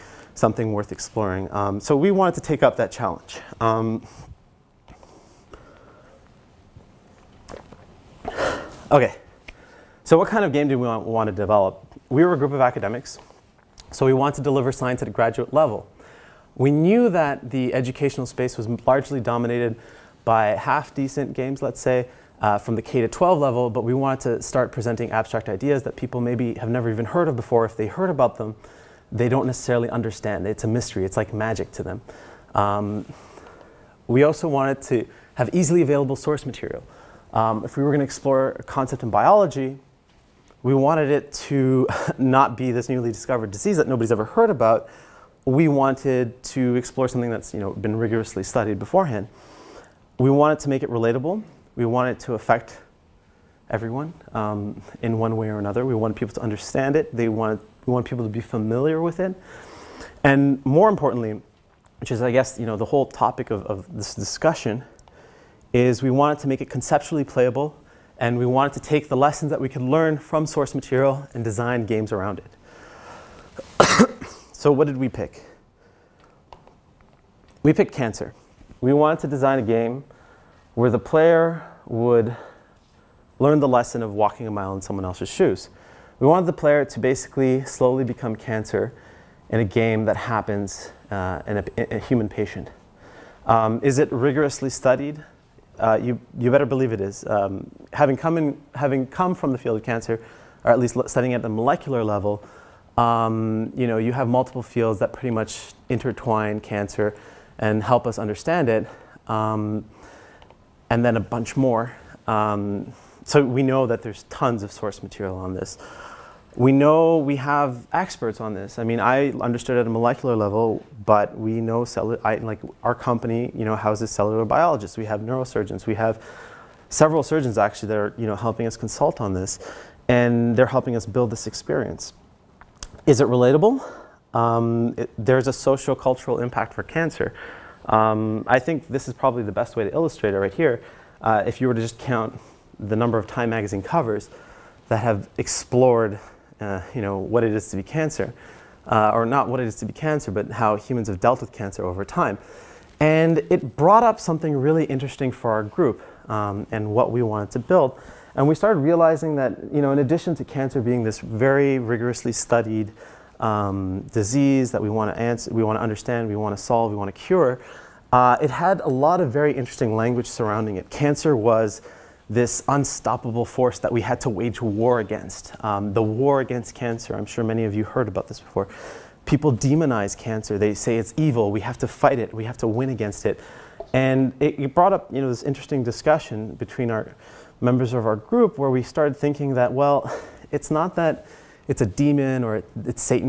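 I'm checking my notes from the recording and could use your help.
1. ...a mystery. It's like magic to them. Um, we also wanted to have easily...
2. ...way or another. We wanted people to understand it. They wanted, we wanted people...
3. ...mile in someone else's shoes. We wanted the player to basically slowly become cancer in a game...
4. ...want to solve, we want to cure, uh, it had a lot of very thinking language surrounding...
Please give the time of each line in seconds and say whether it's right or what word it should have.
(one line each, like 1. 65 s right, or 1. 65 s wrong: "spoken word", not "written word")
1. 30 s right
2. 55 s right
3. 84 s right
4. 166 s wrong: "interesting", not "thinking".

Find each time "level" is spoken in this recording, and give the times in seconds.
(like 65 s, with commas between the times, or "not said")
15 s, 23 s, 102 s, 120 s.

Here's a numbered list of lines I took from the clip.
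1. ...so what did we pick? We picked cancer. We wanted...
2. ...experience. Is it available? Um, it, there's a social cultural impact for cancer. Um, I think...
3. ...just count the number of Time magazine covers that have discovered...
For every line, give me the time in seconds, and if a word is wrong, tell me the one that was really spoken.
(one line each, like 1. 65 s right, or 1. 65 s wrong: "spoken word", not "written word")
1. 74 s right
2. 131 s wrong: "relatable", not "available"
3. 141 s wrong: "explored", not "discovered".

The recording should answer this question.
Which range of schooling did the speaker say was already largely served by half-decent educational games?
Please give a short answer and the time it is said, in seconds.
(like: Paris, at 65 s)
K to 12, at 22 s.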